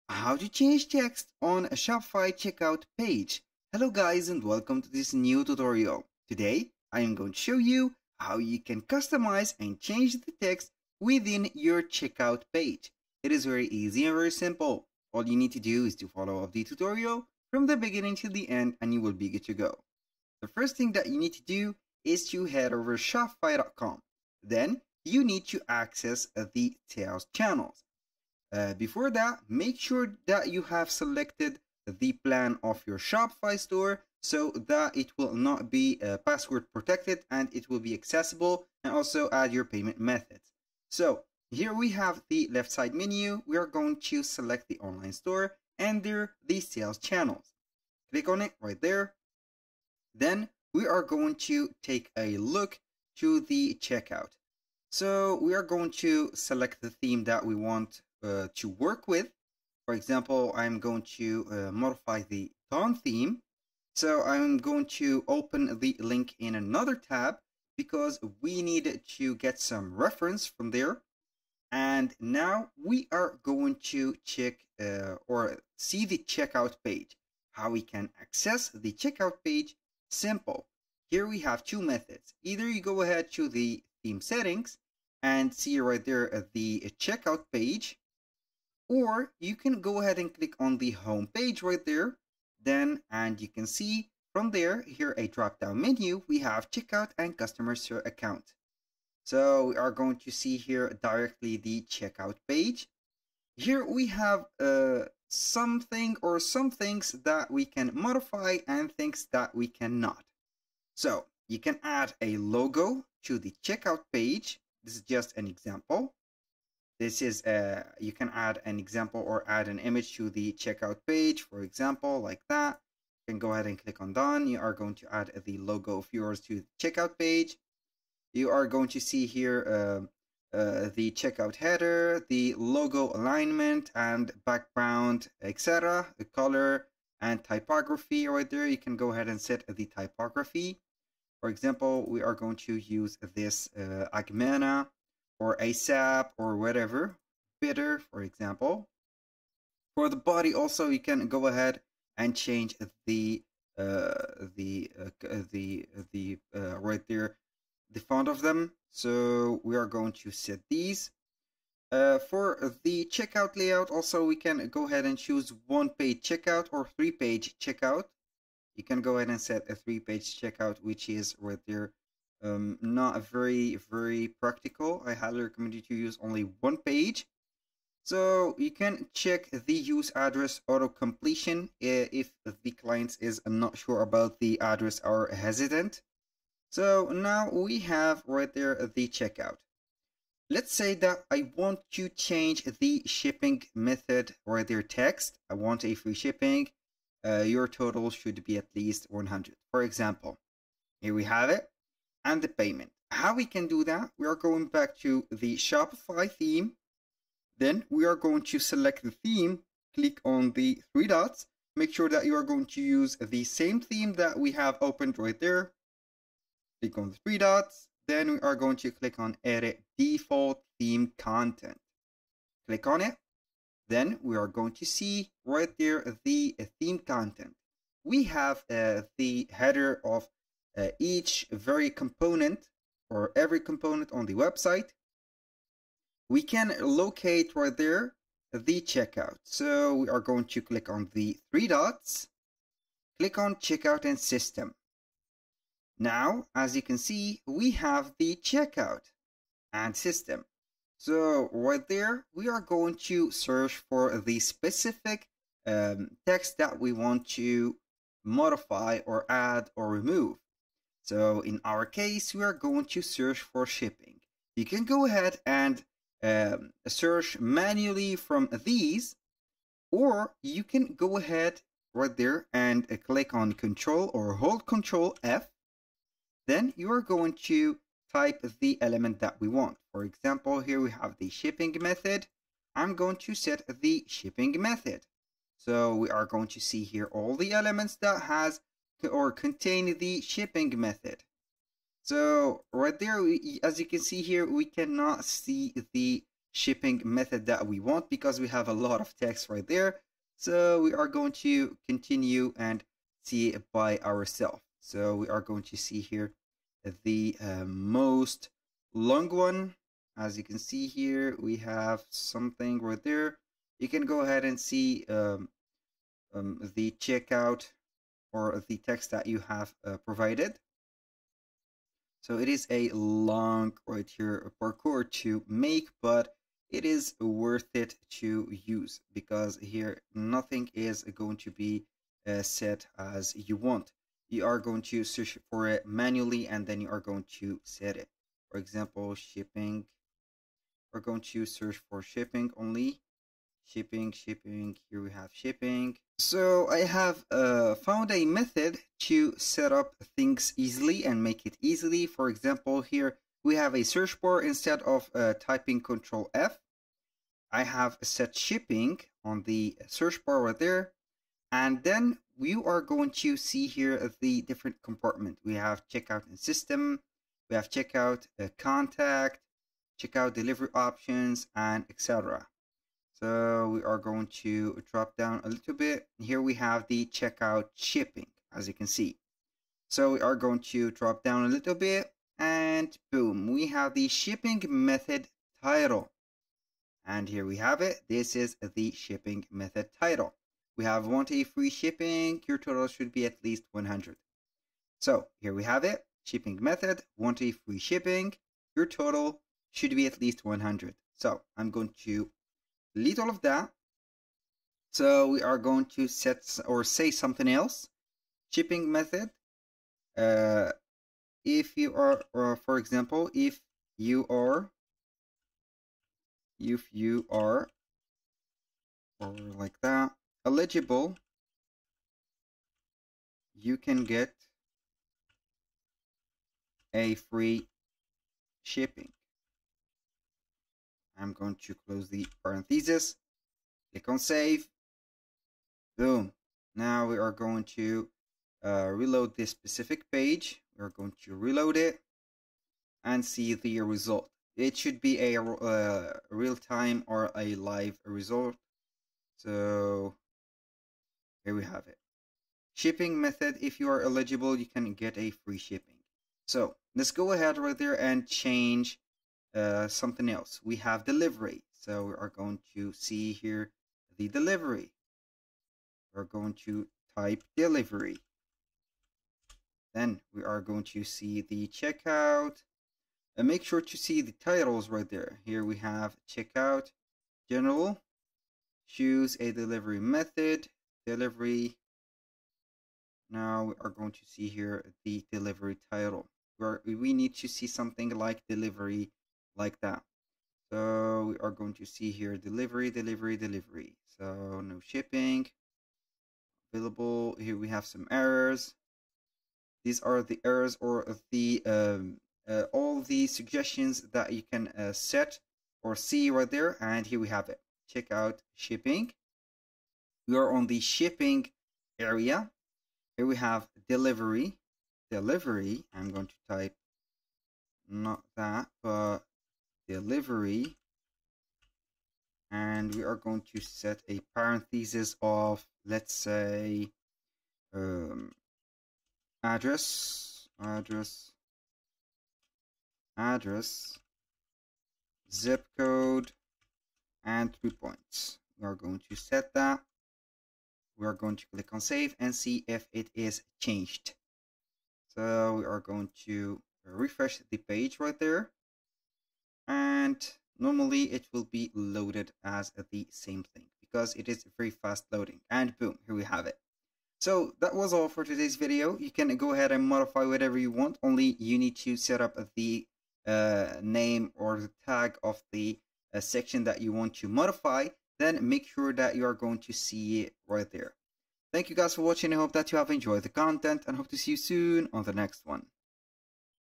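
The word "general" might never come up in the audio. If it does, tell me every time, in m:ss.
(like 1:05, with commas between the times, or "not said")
7:57.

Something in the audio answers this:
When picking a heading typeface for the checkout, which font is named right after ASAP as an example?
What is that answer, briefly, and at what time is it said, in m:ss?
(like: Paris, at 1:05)
Bitter, at 2:27.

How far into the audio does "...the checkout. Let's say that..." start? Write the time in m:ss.
3:08.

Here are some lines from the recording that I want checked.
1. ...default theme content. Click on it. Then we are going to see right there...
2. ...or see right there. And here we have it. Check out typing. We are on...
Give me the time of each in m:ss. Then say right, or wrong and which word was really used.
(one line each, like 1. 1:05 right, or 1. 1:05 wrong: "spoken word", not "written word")
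1. 3:39 right
2. 8:25 wrong: "shipping", not "typing".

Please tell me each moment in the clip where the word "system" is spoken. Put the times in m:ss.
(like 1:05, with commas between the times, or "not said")
4:04, 4:09, 6:06.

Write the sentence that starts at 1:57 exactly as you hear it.
Uh, you can add an example or add an image to the checkout page, for example, like that.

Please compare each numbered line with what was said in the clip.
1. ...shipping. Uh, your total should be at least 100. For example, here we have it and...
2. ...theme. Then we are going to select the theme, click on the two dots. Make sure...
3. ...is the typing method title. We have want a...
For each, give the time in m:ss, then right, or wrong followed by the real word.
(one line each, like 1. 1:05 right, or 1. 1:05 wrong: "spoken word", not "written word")
1. 3:16 right
2. 3:26 wrong: "three", not "two"
3. 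6:28 wrong: "shipping", not "typing".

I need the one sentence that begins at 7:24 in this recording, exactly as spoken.
It should be a uh, real-time or a live result.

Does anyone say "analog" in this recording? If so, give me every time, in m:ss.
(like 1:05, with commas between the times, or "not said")
not said.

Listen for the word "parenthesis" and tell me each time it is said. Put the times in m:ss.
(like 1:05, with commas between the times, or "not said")
7:12, 8:44.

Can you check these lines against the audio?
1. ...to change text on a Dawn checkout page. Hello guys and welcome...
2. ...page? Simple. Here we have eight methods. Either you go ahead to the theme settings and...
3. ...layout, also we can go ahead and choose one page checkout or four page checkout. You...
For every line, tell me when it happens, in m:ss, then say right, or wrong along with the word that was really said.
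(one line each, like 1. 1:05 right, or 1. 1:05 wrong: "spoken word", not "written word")
1. 0:00 wrong: "Shopify", not "Dawn"
2. 1:19 wrong: "two", not "eight"
3. 2:43 wrong: "three", not "four".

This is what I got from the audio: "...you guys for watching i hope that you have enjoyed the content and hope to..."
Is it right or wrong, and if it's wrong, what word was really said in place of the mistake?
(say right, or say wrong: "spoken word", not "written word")
right.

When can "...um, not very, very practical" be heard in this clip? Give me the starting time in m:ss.
2:52.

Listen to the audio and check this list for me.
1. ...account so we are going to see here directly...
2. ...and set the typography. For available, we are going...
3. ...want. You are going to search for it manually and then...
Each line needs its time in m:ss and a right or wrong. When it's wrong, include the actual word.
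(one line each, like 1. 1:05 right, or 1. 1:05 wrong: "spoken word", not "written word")
1. 1:38 right
2. 2:19 wrong: "example", not "available"
3. 5:33 right.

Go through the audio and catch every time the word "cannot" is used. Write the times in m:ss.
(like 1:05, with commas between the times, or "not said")
1:49, 4:54.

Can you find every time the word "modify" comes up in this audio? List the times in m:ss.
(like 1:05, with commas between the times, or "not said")
1:01, 1:47, 4:18, 9:19, 9:27.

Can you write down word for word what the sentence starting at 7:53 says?
And make sure to see the titles right there.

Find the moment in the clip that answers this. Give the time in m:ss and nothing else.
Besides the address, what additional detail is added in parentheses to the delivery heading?
8:55.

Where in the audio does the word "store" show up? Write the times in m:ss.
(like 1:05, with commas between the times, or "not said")
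0:33, 0:45.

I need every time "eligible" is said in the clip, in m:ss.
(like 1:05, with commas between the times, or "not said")
7:00, 7:34.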